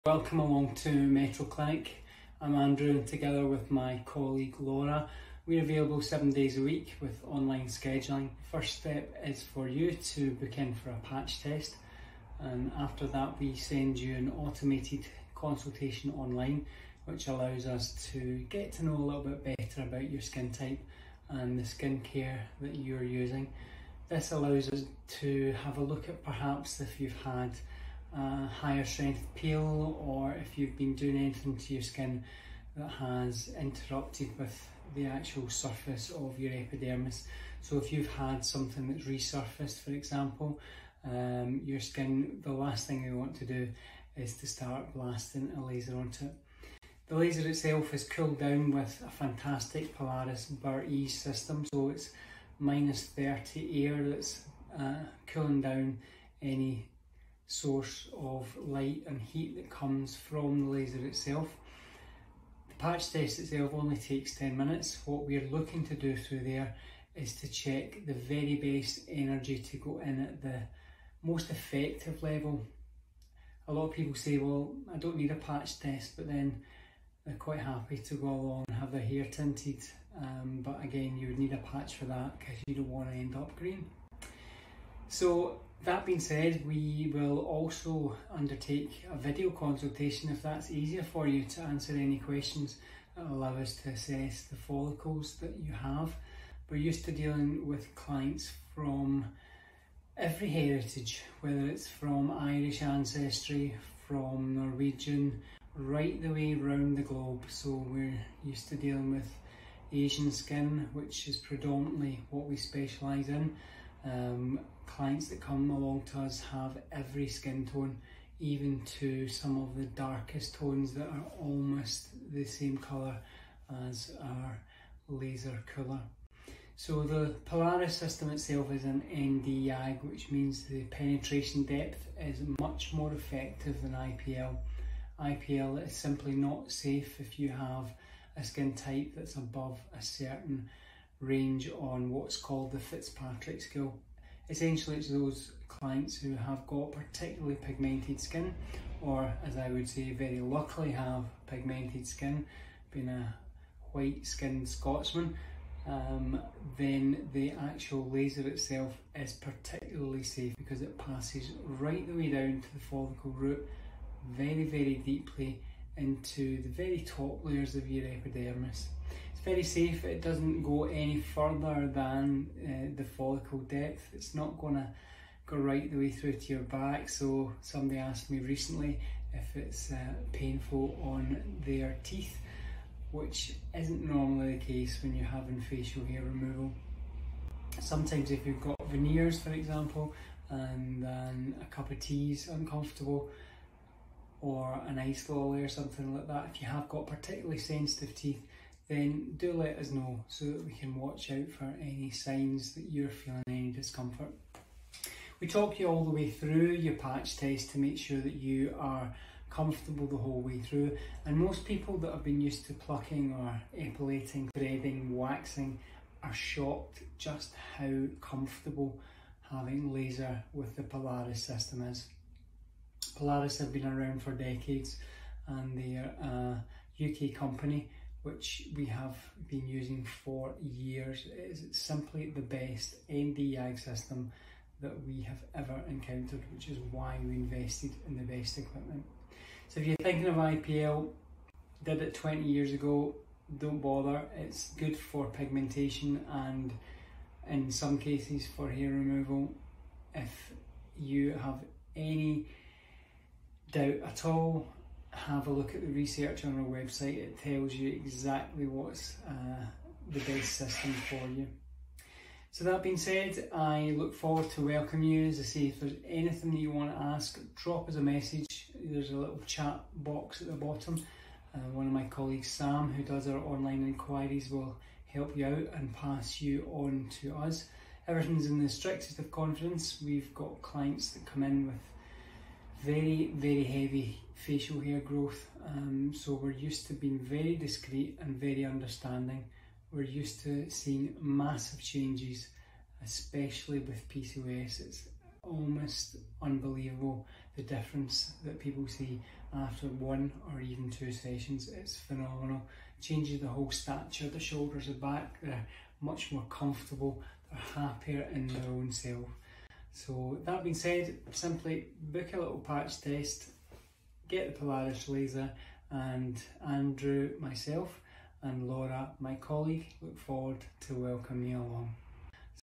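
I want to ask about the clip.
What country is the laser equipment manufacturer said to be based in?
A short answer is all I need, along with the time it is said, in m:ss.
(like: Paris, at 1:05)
UK, at 3:47.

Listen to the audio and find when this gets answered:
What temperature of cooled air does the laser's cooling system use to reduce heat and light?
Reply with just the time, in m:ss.
0:52.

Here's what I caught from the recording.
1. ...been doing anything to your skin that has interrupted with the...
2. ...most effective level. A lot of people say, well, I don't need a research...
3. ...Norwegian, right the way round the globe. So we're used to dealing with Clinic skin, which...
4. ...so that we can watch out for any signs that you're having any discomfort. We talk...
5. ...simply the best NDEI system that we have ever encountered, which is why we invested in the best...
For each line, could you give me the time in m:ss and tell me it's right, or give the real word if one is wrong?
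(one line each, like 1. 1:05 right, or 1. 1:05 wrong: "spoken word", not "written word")
1. 0:30 right
2. 1:11 wrong: "patch", not "research"
3. 1:44 wrong: "Asian", not "Clinic"
4. 3:20 wrong: "feeling", not "having"
5. 3:51 right.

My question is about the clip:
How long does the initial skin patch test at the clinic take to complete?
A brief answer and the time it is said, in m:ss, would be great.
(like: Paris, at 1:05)
10 minutes, at 1:04.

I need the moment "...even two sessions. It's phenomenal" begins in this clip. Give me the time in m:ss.
5:00.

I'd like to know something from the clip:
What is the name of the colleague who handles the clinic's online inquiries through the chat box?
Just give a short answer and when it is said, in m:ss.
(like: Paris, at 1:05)
Sam, at 4:32.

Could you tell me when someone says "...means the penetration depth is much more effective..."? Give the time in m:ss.
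2:10.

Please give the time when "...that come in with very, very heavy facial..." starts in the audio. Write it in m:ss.
4:41.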